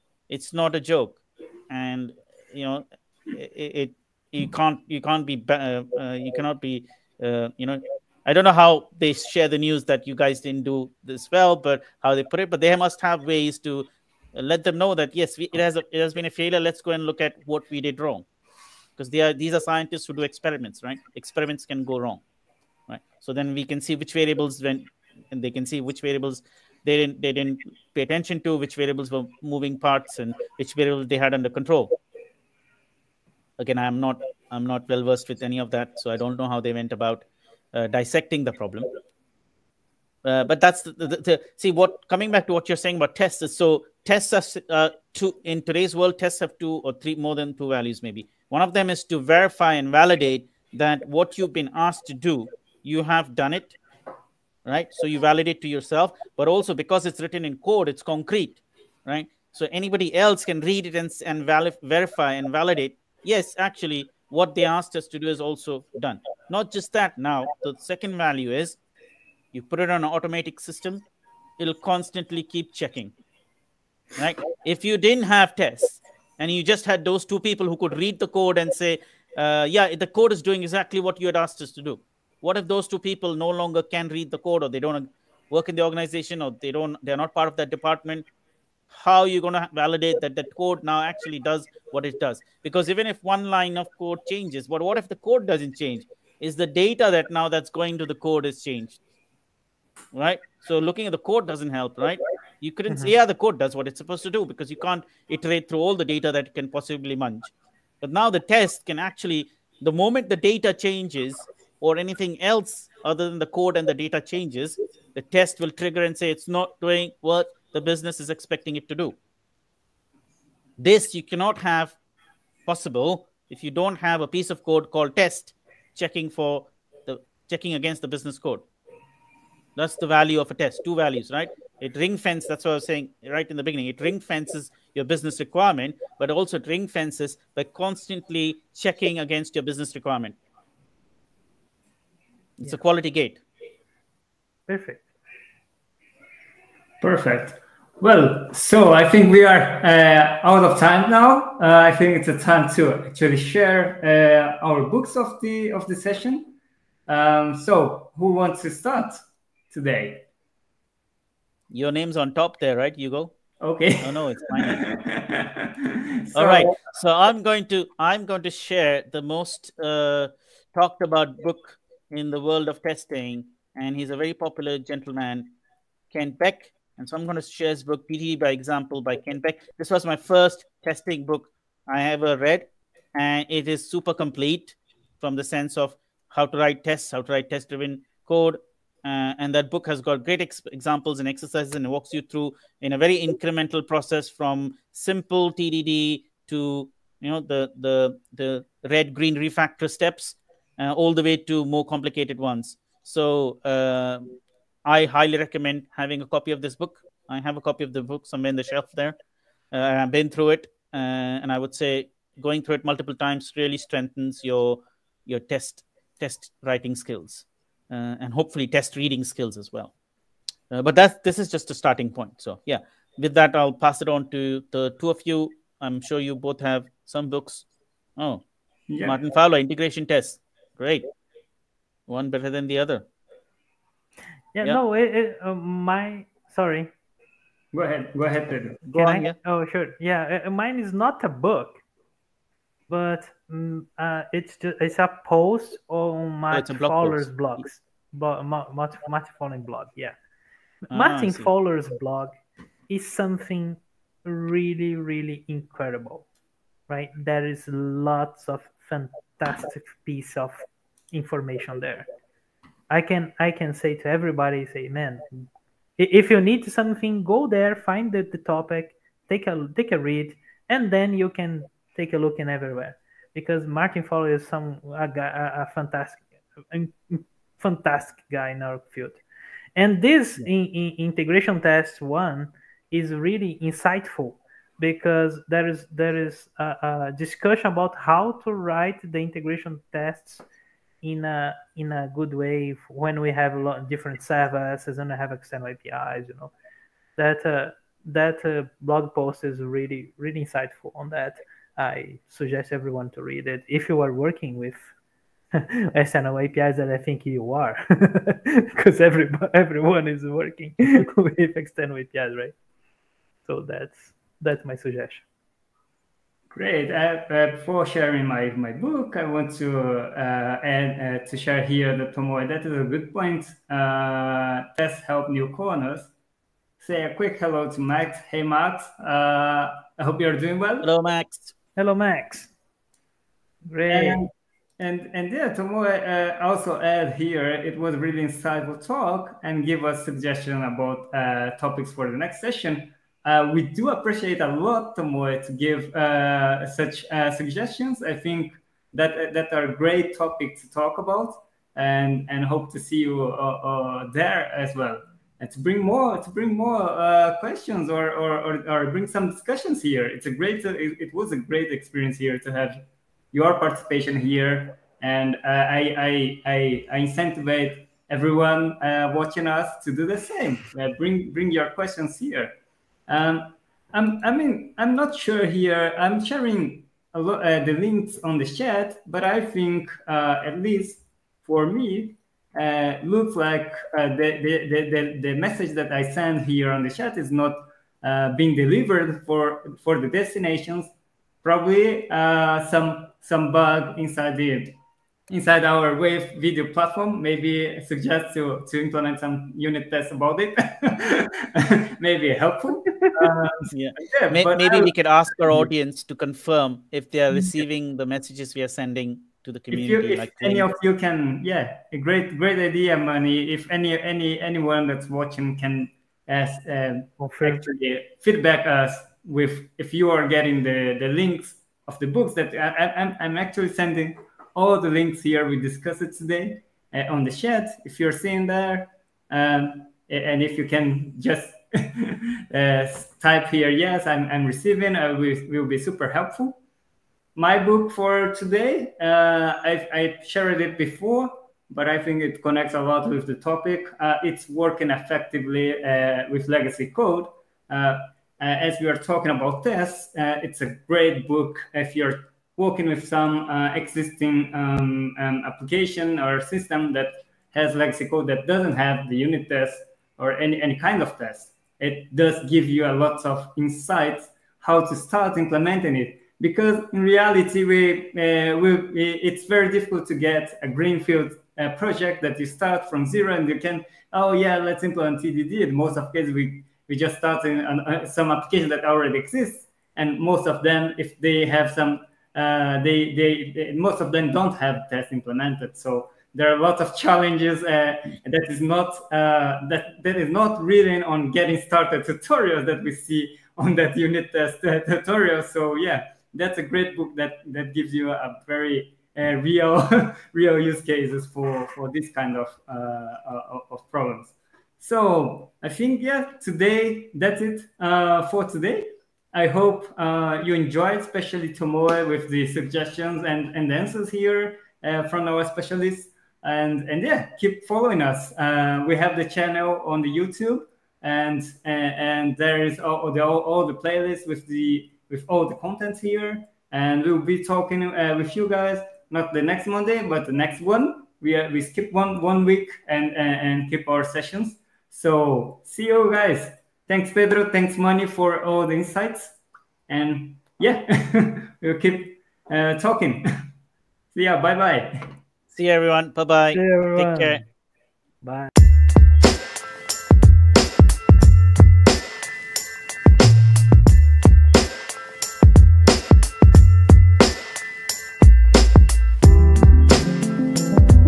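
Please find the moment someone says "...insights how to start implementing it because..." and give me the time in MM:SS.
07:43.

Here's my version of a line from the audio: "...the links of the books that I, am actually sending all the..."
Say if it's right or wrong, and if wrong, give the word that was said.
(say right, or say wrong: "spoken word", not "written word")
right.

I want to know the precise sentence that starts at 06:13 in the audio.
Um, I'm, I mean, I'm not sure here.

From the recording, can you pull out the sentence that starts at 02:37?
Um, so, who wants to start?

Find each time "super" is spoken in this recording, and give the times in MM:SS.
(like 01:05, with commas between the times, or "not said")
03:03, 07:15.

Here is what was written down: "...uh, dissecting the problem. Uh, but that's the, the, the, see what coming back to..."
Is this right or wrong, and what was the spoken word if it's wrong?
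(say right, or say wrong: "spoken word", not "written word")
right.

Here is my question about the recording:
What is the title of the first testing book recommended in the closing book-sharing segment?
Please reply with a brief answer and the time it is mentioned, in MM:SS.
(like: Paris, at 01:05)
TDD by Example, at 02:58.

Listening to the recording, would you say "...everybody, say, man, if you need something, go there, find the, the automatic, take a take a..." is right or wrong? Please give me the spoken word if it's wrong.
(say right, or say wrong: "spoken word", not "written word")
wrong: "topic", not "automatic".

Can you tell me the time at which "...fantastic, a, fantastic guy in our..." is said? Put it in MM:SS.
04:35.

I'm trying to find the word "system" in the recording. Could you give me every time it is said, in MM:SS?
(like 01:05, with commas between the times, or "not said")
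01:10, 07:36.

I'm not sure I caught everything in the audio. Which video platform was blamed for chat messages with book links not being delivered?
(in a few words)
Wave.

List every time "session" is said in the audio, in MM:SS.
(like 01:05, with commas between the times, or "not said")
02:35, 05:42, 08:54.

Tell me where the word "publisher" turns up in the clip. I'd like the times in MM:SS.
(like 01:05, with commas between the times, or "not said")
not said.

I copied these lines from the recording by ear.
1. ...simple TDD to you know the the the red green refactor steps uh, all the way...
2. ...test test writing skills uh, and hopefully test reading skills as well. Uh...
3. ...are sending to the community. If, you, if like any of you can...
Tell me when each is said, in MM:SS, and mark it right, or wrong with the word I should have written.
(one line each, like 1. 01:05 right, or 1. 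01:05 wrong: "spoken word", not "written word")
1. 03:14 right
2. 03:35 right
3. 06:48 right.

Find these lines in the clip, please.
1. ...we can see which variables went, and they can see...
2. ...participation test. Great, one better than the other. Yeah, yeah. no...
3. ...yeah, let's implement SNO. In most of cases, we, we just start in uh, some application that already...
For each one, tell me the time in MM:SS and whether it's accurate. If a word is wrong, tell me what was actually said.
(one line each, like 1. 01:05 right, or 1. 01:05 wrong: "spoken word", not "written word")
1. 00:23 right
2. 03:49 wrong: "integration", not "participation"
3. 07:54 wrong: "TDD", not "SNO".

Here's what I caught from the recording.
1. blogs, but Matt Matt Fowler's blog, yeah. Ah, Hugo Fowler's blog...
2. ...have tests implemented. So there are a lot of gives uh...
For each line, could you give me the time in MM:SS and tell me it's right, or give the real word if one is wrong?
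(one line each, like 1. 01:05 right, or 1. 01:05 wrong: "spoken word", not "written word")
1. 04:07 wrong: "Martin", not "Hugo"
2. 08:04 wrong: "challenges", not "gives".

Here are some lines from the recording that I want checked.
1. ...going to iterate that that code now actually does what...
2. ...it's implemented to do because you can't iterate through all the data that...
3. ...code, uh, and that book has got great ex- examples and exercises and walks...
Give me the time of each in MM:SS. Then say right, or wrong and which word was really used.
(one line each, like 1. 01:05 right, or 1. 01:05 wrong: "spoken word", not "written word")
1. 01:29 wrong: "validate", not "iterate"
2. 01:43 wrong: "supposed", not "implemented"
3. 03:08 right.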